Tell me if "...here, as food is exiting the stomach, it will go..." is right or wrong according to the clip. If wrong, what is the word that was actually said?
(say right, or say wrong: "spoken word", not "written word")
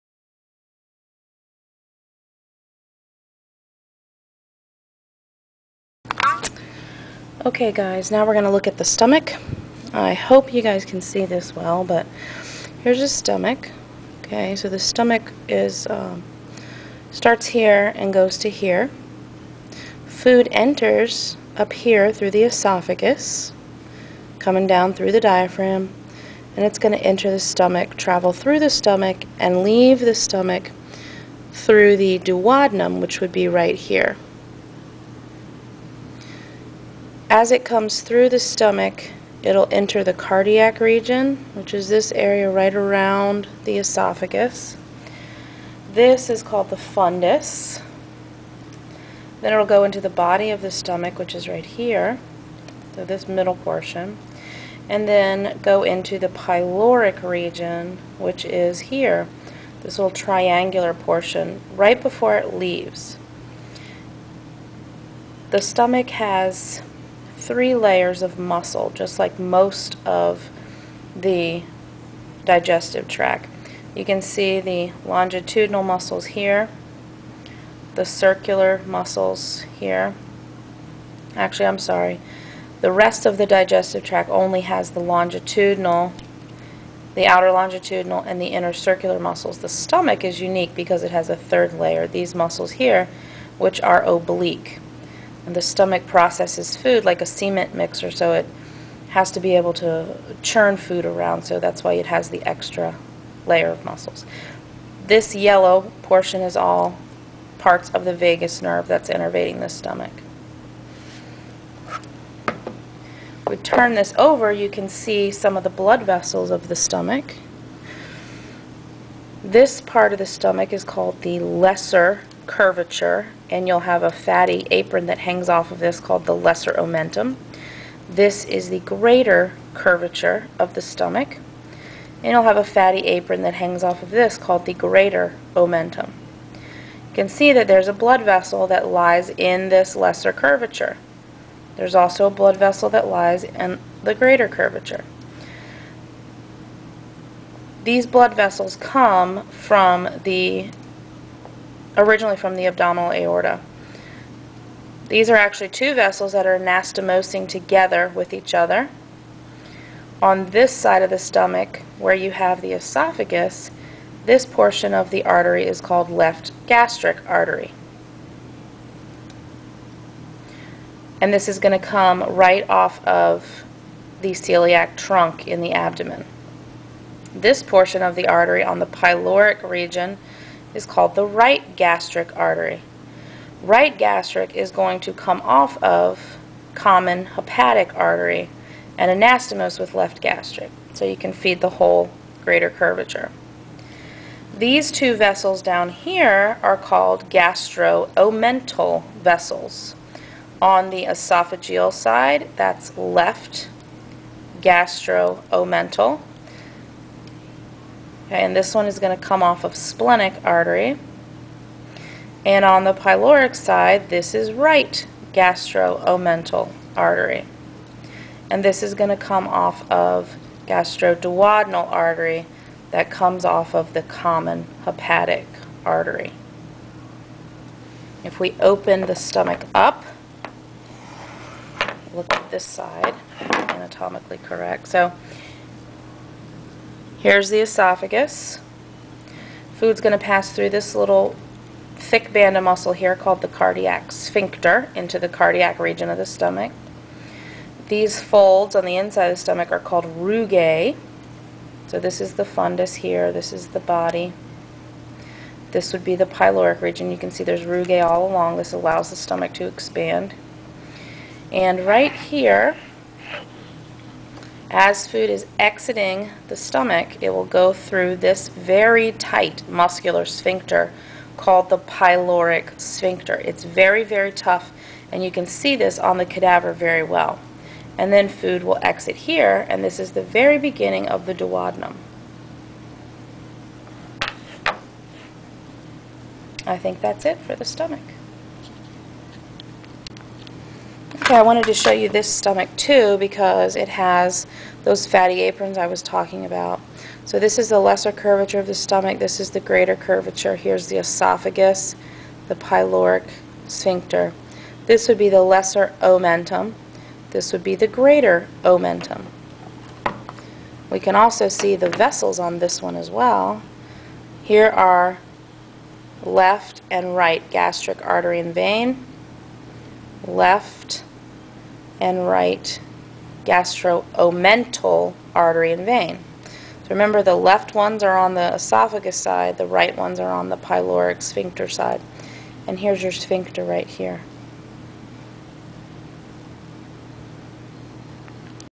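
right.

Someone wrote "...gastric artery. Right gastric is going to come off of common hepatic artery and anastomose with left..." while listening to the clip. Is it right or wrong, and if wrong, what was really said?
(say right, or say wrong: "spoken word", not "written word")
right.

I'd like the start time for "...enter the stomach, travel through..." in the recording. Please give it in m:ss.
0:27.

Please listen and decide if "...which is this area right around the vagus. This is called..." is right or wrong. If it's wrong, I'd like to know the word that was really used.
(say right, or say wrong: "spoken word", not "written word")
wrong: "esophagus", not "vagus".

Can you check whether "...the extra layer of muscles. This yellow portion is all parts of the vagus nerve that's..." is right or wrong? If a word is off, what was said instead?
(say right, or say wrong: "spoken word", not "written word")
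right.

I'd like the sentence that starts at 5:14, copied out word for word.
Here are left and right gastric artery and vein, left and right gastroomental artery and vein.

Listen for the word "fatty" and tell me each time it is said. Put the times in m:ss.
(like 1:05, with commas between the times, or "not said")
2:04, 2:12, 4:55.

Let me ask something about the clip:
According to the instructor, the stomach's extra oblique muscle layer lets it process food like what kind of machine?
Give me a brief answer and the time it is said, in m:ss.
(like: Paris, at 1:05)
cement mixer, at 1:37.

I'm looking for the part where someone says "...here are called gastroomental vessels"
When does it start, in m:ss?
3:15.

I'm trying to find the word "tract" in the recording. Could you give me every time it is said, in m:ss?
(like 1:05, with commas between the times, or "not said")
1:13, 1:24.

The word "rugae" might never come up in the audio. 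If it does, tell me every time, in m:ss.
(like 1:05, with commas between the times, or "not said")
4:10, 4:17.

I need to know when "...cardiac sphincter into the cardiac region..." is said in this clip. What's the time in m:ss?
4:03.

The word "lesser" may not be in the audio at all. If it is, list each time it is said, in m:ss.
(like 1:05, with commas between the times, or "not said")
2:01, 2:06, 2:19, 4:57, 5:05.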